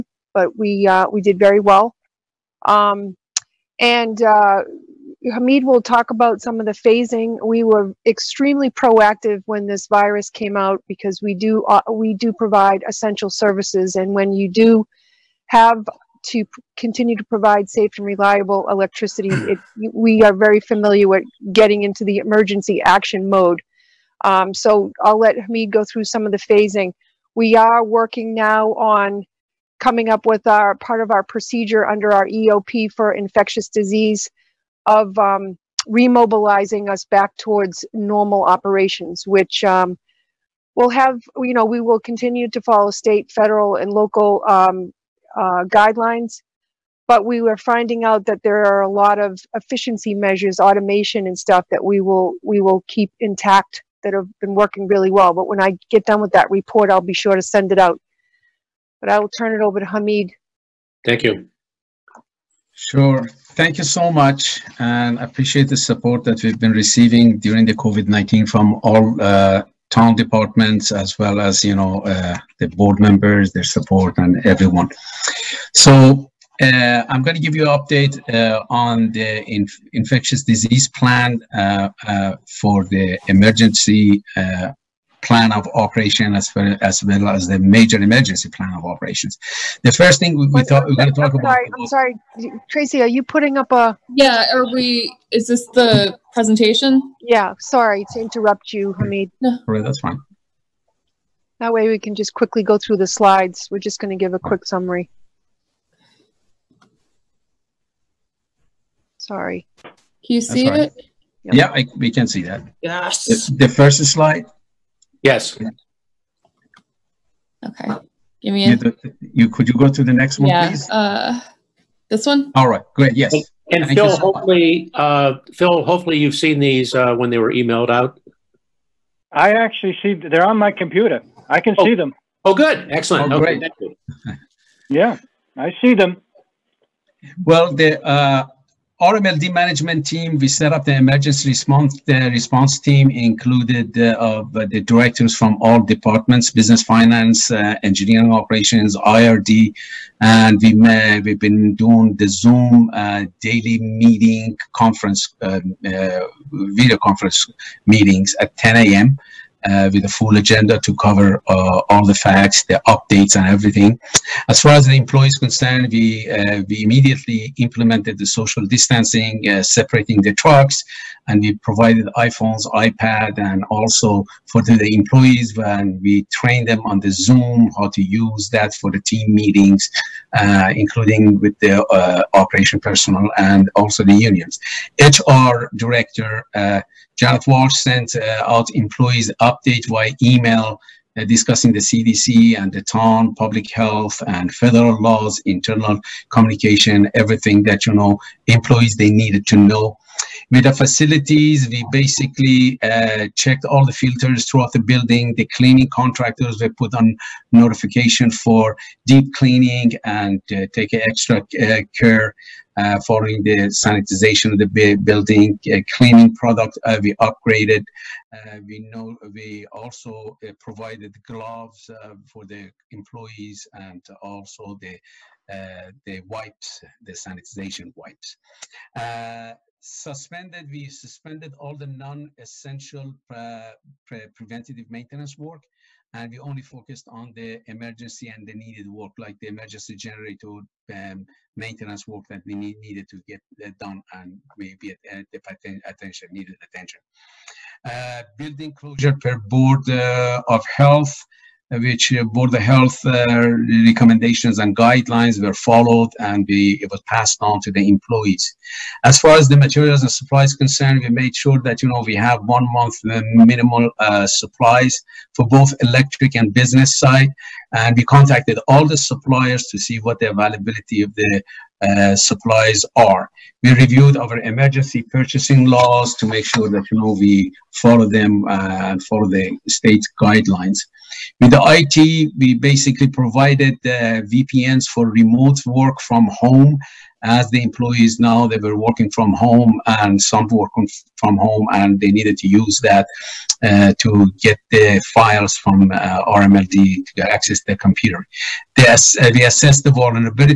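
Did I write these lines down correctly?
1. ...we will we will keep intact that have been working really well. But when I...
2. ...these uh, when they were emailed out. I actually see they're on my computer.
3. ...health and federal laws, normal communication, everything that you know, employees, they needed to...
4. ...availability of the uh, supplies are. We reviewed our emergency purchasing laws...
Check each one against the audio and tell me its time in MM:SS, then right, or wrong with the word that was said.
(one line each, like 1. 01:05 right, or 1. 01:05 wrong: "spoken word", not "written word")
1. 00:51 right
2. 02:06 right
3. 03:13 wrong: "internal", not "normal"
4. 04:30 right.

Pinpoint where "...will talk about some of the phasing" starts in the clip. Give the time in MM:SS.
00:05.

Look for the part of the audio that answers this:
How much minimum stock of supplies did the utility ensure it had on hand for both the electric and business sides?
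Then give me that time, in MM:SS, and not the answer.
04:22.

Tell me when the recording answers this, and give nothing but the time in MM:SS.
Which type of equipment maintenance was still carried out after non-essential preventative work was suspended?
03:59.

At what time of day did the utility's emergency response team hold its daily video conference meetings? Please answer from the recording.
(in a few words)
10 a.m.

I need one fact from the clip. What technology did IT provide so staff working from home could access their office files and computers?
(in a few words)
VPNs.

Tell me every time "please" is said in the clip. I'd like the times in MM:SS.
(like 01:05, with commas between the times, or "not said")
02:00.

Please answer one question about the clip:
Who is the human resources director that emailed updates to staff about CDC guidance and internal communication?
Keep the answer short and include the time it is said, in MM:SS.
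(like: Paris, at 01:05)
Janet Walsh, at 03:07.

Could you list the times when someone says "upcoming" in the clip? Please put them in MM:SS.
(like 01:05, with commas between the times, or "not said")
not said.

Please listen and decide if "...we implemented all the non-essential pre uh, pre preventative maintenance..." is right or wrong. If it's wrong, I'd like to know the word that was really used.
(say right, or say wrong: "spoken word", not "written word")
wrong: "suspended", not "implemented".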